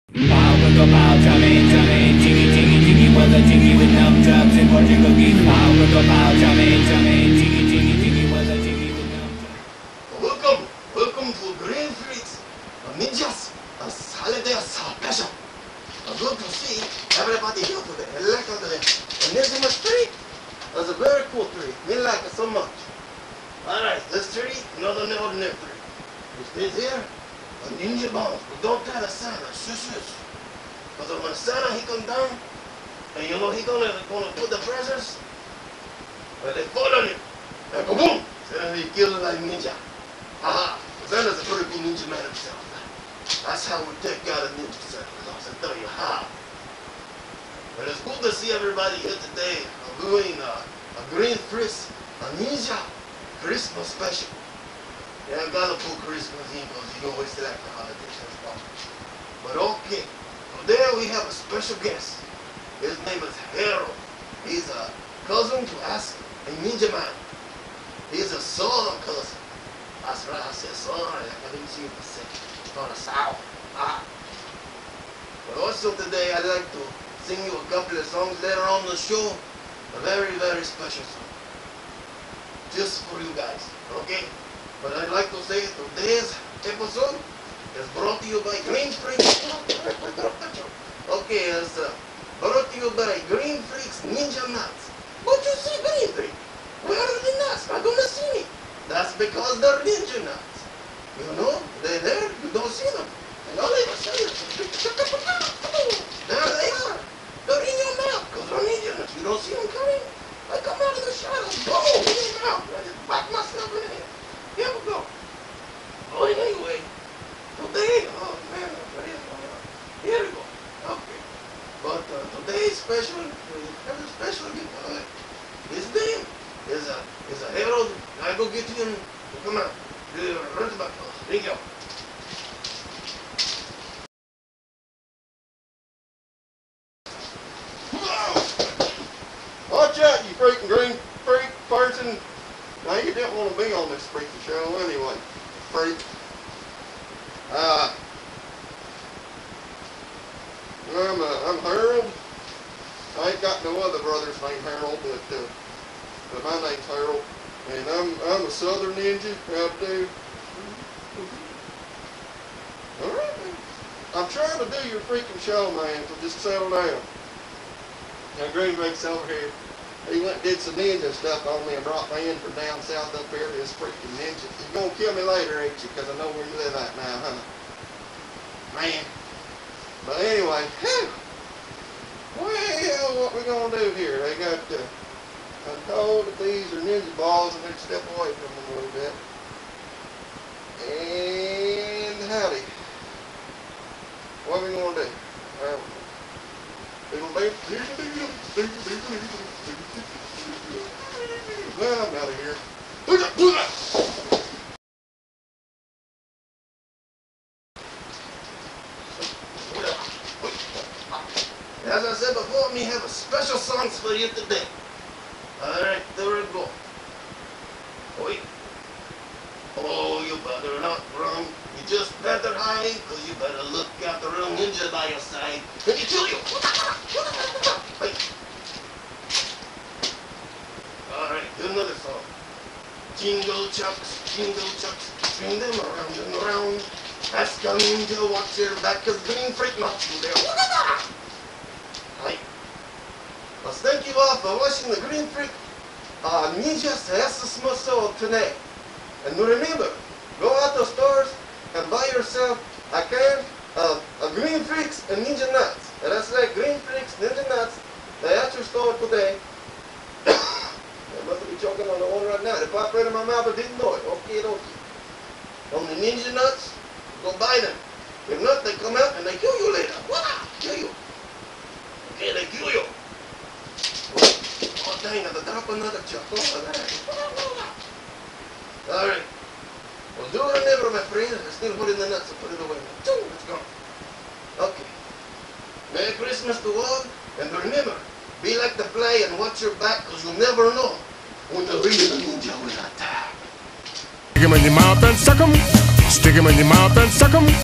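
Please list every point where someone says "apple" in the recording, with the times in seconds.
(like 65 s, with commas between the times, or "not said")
not said.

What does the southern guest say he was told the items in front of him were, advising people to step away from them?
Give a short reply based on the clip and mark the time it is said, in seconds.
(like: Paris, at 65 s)
Ninja balls, at 186 s.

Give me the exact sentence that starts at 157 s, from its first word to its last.
And I'm, I'm a southern ninja out there.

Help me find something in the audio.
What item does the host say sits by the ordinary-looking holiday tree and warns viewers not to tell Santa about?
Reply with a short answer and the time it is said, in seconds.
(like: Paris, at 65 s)
Ninja bomb, at 27 s.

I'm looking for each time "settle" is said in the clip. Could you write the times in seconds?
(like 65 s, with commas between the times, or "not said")
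166 s.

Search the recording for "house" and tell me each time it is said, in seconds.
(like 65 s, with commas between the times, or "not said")
130 s.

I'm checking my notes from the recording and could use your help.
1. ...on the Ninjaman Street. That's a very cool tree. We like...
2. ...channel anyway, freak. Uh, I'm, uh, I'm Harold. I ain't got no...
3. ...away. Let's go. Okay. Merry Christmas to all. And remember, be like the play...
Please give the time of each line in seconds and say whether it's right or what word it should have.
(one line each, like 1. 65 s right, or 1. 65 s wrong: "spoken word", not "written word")
1. 18 s wrong: "Enigma", not "Ninjaman"
2. 144 s right
3. 282 s right.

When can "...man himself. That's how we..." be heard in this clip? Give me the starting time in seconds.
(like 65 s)
42 s.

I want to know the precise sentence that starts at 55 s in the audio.
Yeah, I gotta put Christmas in because you always like the holidays and stuff.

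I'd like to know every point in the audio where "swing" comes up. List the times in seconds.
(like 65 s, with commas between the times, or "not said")
235 s.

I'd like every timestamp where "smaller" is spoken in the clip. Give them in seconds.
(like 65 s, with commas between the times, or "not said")
not said.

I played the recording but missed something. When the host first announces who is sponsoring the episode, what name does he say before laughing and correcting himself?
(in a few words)
Green Spring.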